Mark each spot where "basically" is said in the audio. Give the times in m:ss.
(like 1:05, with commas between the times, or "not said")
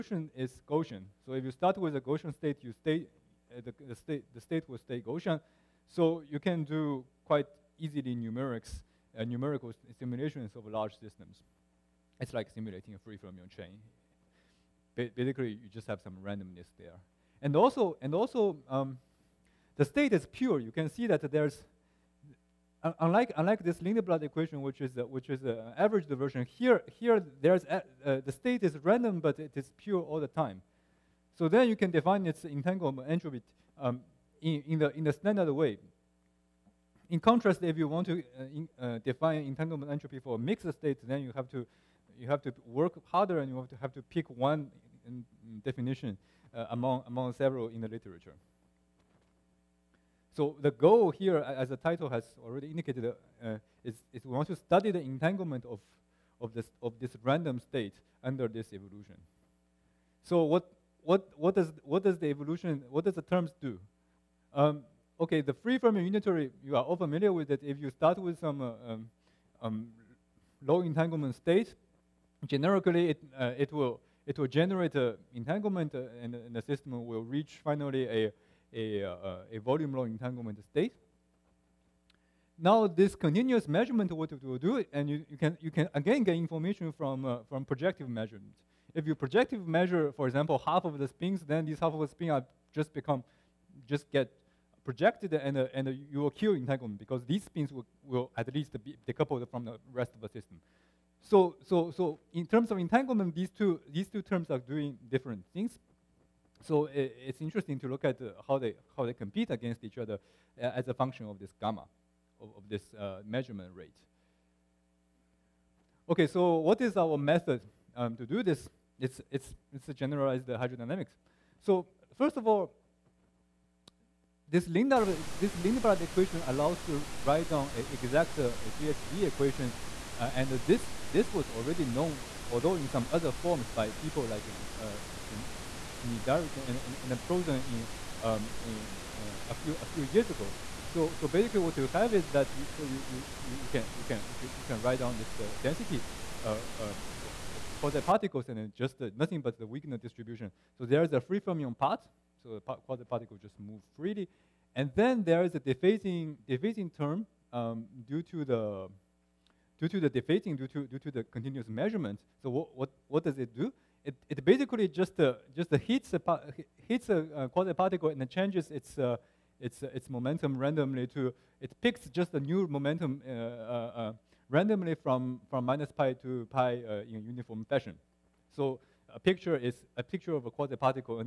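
0:15, 2:21, 2:44.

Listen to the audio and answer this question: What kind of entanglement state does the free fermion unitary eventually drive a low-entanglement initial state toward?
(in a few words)
volume law entanglement state.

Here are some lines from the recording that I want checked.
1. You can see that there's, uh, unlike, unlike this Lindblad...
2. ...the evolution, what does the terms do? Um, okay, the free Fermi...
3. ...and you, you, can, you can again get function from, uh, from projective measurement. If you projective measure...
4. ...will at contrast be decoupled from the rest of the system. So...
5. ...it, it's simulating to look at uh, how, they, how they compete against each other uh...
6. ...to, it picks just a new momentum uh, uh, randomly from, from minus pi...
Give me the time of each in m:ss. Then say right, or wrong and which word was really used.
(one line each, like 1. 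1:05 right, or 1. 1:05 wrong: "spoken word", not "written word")
1. 0:20 right
2. 1:02 right
3. 1:24 wrong: "information", not "function"
4. 1:38 wrong: "least", not "contrast"
5. 1:46 wrong: "interesting", not "simulating"
6. 2:51 right.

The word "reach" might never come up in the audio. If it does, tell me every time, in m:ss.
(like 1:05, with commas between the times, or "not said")
1:17.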